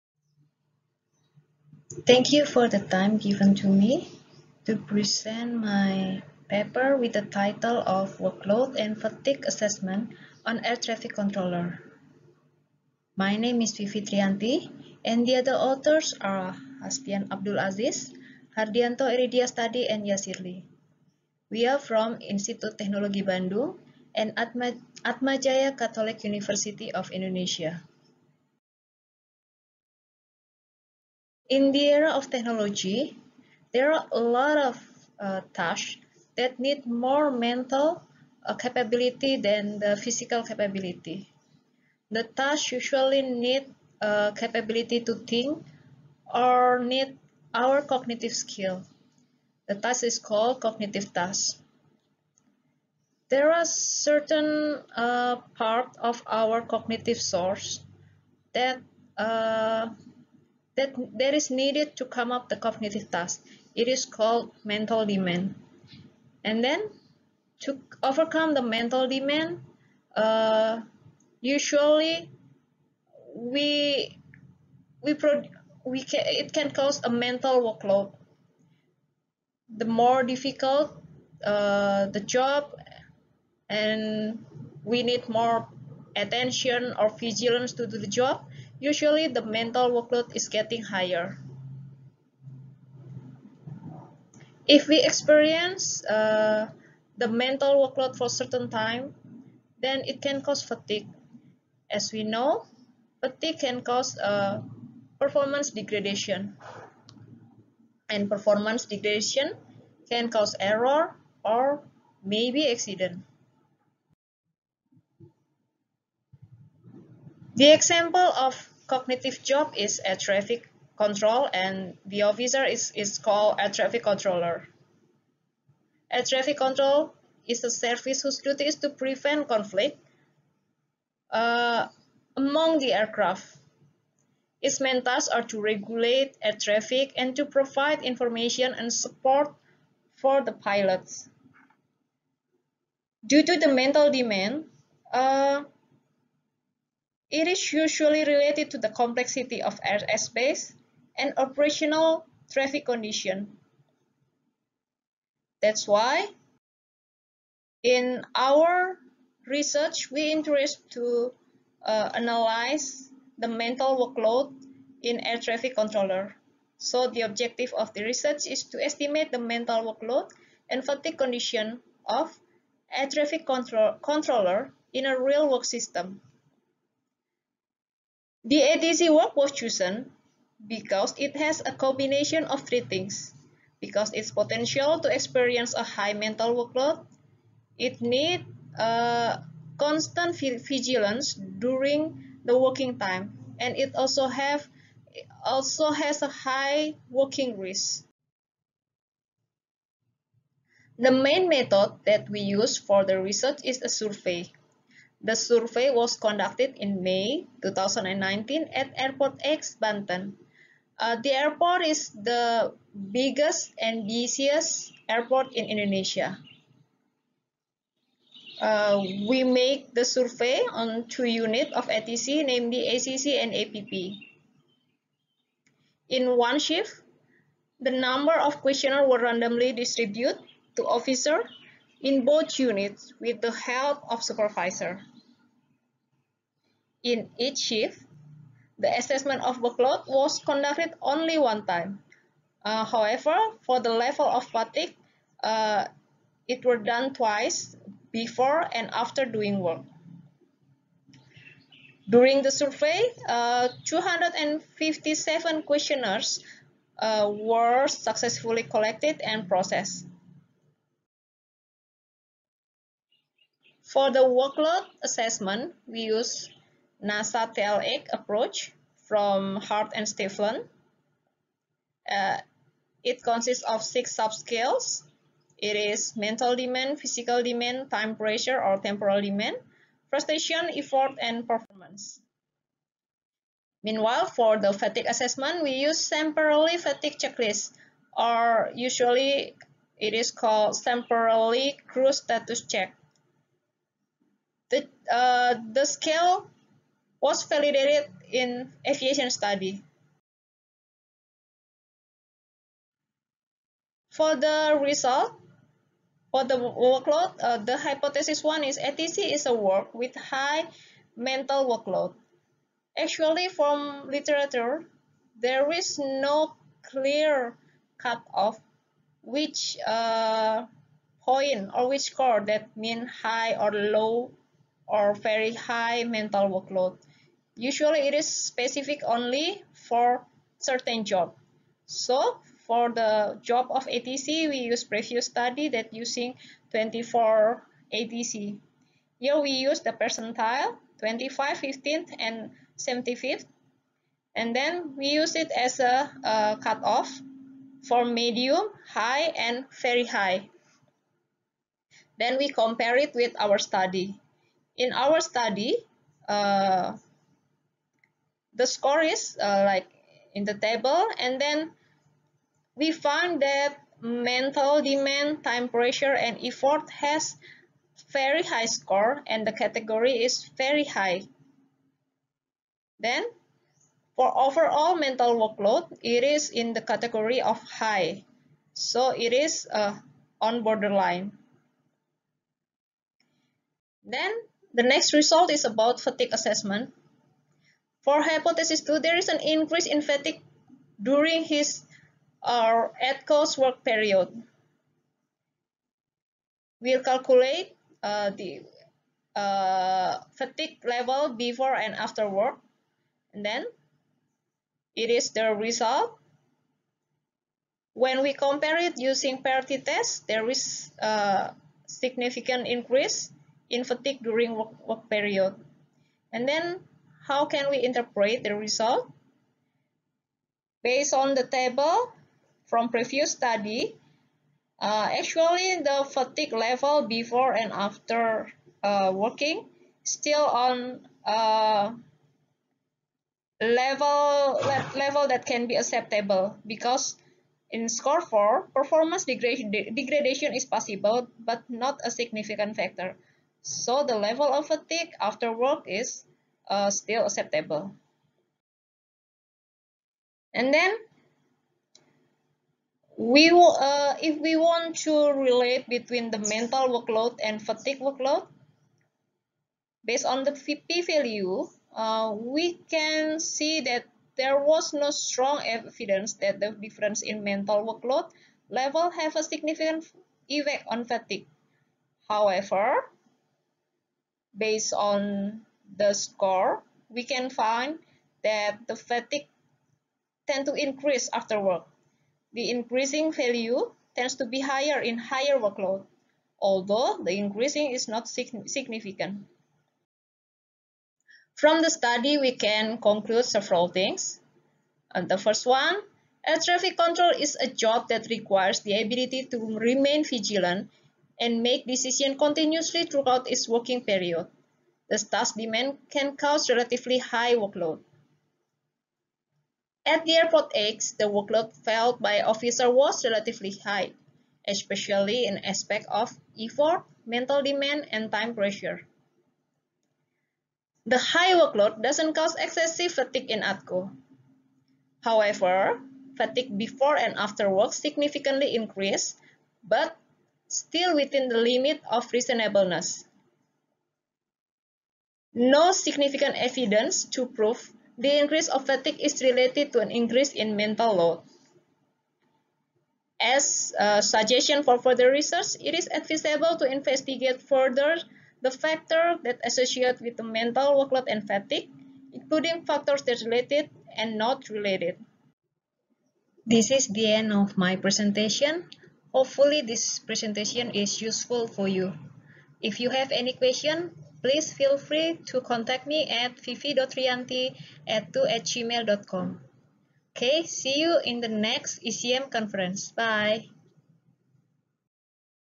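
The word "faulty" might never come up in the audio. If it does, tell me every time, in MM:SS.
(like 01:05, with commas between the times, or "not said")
not said.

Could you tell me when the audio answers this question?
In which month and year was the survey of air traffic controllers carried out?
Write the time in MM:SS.
03:27.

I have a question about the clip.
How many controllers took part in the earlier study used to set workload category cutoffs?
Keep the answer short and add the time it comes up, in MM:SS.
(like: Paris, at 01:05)
24, at 05:36.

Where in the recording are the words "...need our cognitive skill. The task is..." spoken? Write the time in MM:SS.
00:46.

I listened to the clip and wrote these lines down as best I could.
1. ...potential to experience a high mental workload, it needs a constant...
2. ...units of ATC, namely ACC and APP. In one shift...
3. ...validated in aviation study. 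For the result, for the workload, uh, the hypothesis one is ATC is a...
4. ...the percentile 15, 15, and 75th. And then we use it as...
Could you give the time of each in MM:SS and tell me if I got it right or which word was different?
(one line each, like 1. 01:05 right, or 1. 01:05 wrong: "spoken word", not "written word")
1. 03:04 right
2. 03:41 right
3. 04:57 right
4. 05:39 wrong: "25", not "15".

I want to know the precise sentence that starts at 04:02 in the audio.
Uh, however, for the level of fatigue, uh, it were done twice before and after doing work.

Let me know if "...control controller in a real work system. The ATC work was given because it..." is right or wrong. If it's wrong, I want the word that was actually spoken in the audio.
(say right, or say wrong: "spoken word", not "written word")
wrong: "chosen", not "given".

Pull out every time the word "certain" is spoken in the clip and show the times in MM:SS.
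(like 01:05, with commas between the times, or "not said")
00:53, 01:38, 05:30.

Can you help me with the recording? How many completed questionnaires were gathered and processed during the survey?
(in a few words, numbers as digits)
257.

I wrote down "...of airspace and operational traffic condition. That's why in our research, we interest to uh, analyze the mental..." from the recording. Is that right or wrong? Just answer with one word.
right.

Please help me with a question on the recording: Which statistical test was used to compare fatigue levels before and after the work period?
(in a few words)
paired t-test.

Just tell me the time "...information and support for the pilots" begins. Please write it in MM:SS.
02:18.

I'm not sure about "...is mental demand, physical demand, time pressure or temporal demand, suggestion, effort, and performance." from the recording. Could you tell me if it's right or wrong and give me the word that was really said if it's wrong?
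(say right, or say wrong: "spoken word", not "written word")
wrong: "frustration", not "suggestion".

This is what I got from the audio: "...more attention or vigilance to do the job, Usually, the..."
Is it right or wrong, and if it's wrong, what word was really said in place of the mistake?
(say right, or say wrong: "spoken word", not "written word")
right.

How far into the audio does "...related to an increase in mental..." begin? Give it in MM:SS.
08:59.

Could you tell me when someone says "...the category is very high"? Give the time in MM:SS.
06:09.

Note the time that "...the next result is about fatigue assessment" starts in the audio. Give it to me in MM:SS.
06:24.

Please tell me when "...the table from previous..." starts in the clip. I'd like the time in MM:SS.
07:01.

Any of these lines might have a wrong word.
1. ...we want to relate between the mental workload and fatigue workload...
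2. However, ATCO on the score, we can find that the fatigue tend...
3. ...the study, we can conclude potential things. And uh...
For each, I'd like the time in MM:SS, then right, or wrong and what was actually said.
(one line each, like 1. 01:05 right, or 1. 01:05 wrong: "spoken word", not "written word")
1. 07:34 right
2. 07:52 wrong: "Based", not "ATCO"
3. 08:11 wrong: "several", not "potential".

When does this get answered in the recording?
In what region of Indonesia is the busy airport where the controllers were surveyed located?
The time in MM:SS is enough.
03:29.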